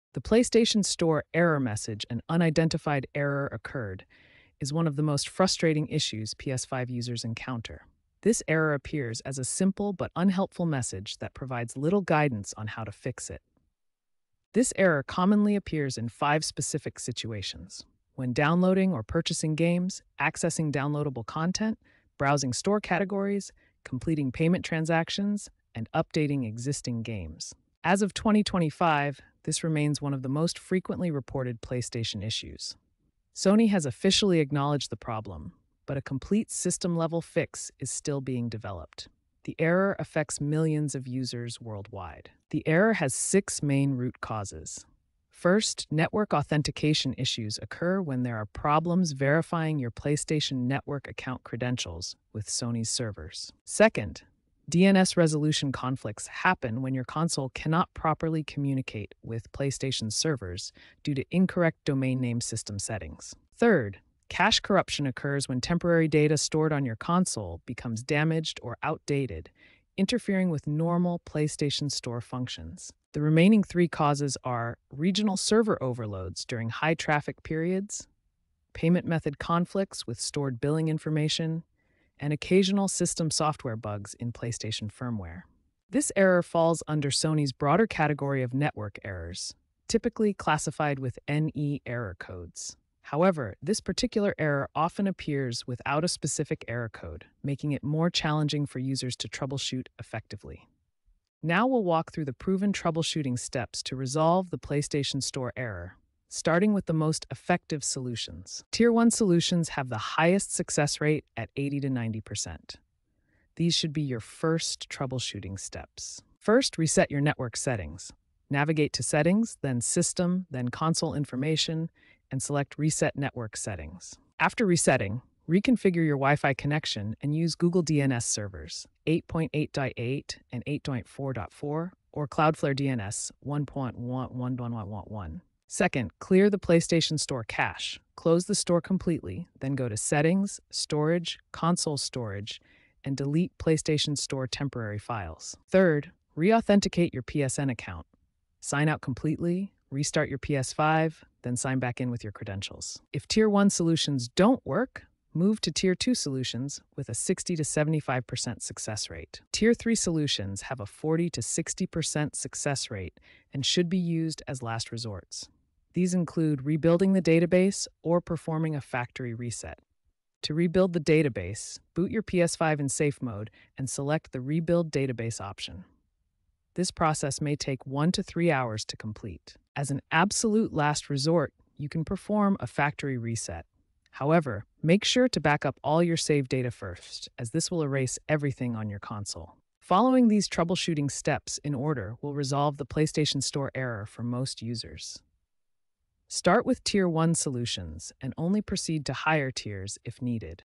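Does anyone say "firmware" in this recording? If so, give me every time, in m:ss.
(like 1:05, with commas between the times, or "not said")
1:24.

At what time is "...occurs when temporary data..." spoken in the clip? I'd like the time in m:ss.
1:05.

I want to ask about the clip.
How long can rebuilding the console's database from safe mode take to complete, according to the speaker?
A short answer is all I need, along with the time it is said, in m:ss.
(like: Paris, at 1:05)
1 to 3 hours, at 2:57.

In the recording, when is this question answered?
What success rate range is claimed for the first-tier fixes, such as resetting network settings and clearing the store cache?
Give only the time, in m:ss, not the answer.
1:51.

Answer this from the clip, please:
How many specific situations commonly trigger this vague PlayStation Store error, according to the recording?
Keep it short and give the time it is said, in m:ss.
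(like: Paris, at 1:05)
5, at 0:16.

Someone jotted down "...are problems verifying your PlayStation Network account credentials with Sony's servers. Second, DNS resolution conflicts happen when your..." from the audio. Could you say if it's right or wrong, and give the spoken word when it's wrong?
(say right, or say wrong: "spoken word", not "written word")
right.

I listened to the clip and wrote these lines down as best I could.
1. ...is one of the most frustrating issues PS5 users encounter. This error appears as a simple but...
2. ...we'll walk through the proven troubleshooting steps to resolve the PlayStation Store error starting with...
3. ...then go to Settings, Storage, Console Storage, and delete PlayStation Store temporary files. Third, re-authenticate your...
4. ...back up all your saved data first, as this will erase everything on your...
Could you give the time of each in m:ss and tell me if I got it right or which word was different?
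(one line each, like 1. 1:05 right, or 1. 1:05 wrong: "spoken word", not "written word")
1. 0:04 right
2. 1:41 right
3. 2:19 right
4. 3:05 right.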